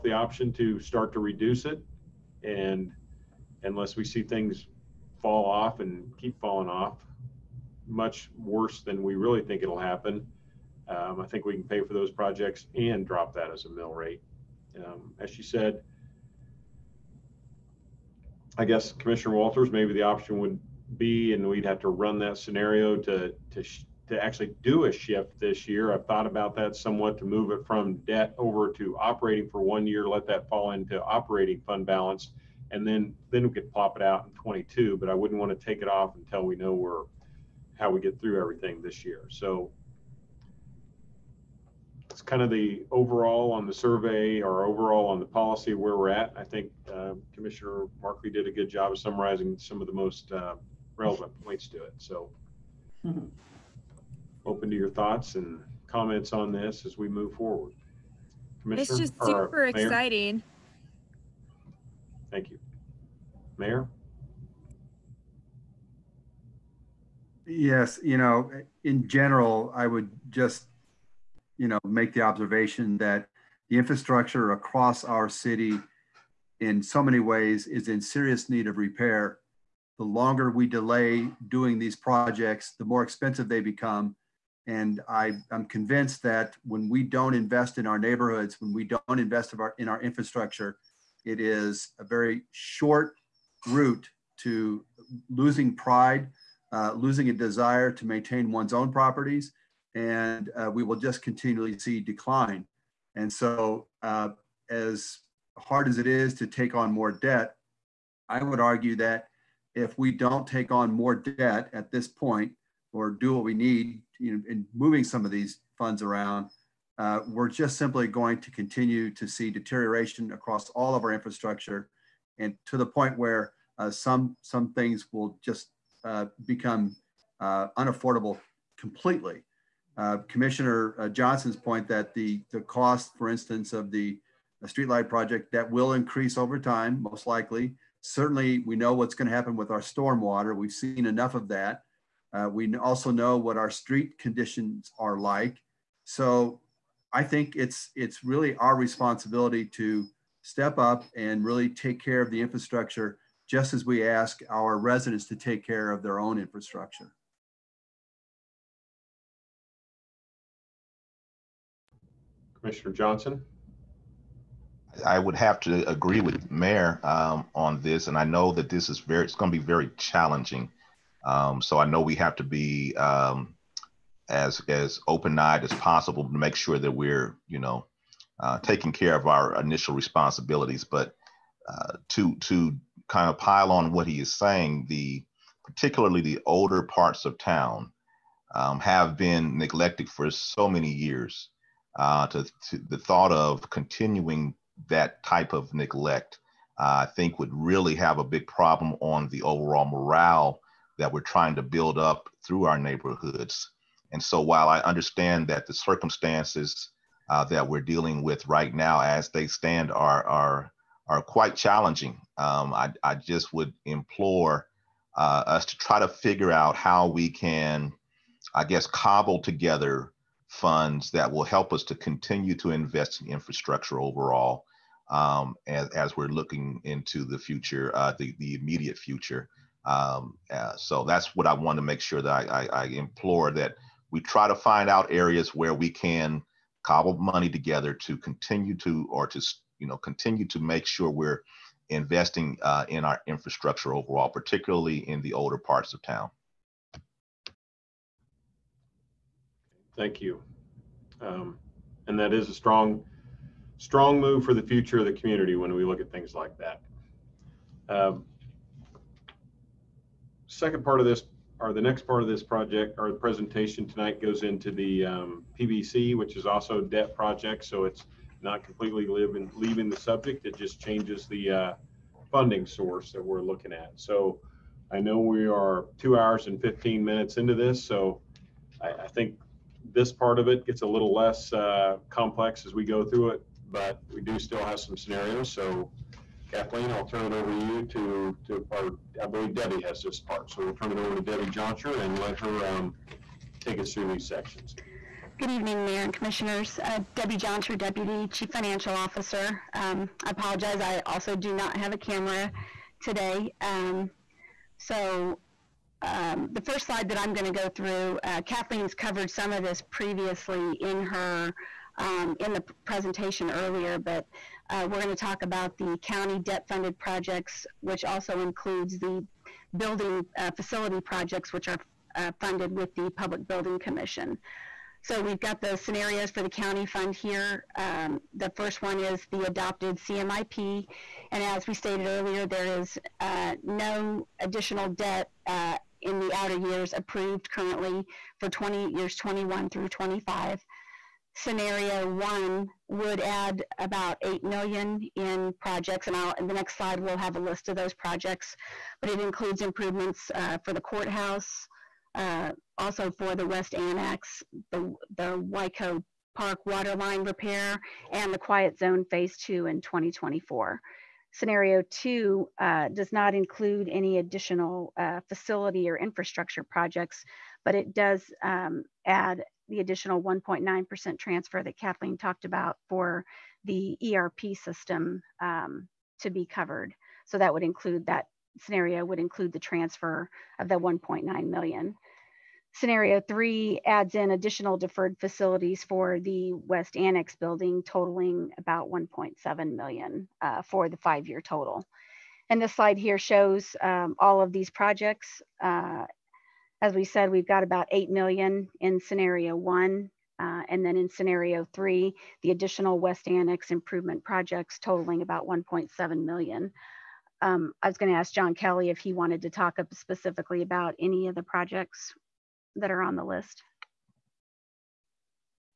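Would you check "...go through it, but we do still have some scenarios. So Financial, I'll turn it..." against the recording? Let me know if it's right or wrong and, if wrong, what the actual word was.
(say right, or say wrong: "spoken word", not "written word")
wrong: "Kathleen", not "Financial".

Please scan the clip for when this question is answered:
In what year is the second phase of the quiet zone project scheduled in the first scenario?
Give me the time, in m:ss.
5:59.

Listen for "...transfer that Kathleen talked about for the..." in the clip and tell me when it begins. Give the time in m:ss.
6:11.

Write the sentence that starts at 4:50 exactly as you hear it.
So we'll turn it over to Debbie Jonscher and let her um, take us through these sections.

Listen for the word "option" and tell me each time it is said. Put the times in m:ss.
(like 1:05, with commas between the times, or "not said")
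0:00, 0:20.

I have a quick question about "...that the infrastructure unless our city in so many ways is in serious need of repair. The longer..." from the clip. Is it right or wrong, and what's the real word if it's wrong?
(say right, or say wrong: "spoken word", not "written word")
wrong: "across", not "unless".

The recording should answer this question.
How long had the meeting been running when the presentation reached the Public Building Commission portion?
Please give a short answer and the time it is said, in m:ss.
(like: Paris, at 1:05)
2 hours and 15 minutes, at 4:35.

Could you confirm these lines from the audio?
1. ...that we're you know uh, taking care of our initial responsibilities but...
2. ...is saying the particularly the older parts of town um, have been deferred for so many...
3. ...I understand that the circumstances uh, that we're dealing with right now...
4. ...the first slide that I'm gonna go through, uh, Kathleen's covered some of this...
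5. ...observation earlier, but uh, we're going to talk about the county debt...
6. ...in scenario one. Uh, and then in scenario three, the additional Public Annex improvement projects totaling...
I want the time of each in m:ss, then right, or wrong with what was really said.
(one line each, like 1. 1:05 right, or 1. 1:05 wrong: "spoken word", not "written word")
1. 2:56 right
2. 3:04 wrong: "neglected", not "deferred"
3. 3:24 right
4. 5:06 right
5. 5:12 wrong: "presentation", not "observation"
6. 6:38 wrong: "West", not "Public".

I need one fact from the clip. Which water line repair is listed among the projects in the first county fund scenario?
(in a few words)
Wyco Park.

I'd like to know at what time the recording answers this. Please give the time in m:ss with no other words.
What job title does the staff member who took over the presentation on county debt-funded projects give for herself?
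4:57.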